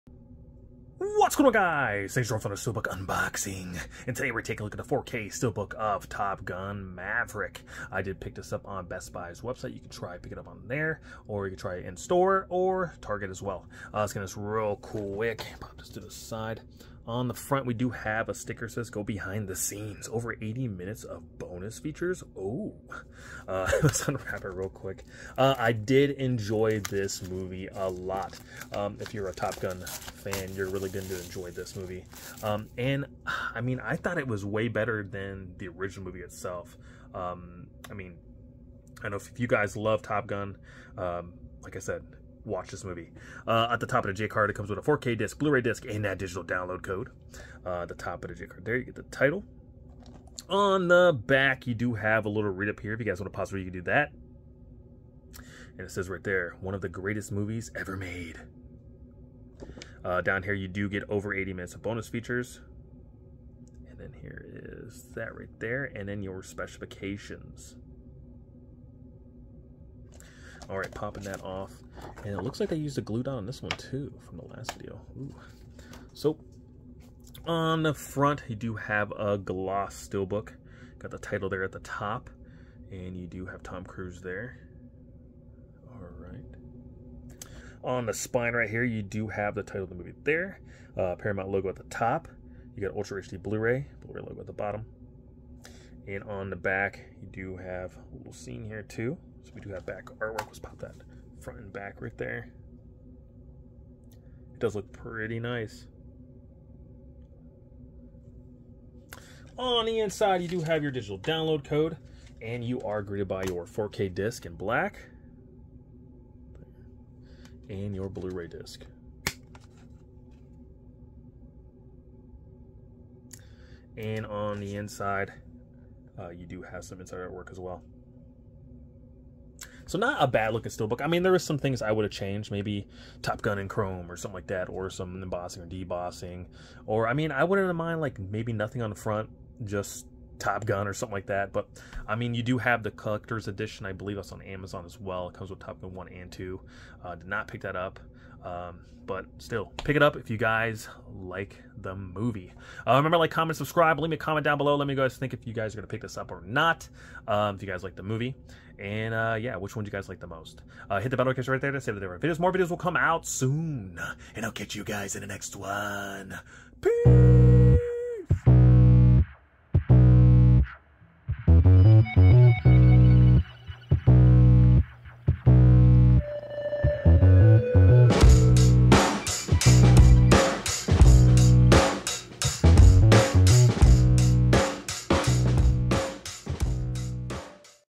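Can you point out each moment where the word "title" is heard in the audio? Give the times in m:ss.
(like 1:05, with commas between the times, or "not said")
0:49, 1:21, 1:29.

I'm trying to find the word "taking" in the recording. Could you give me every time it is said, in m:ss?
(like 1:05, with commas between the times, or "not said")
0:04.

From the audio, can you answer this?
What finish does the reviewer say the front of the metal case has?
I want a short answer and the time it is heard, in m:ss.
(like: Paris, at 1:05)
Gloss, at 1:19.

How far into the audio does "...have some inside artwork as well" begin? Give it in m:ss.
2:06.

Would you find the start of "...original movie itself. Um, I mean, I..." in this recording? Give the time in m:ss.
0:35.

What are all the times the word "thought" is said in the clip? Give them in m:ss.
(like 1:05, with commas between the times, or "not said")
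0:33.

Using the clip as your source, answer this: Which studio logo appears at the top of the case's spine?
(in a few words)
Paramount.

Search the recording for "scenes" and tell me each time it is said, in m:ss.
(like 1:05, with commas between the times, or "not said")
0:19, 1:38.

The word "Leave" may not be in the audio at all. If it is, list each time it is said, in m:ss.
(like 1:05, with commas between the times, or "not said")
2:33.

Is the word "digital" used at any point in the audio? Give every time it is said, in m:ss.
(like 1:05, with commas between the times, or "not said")
0:46, 1:50.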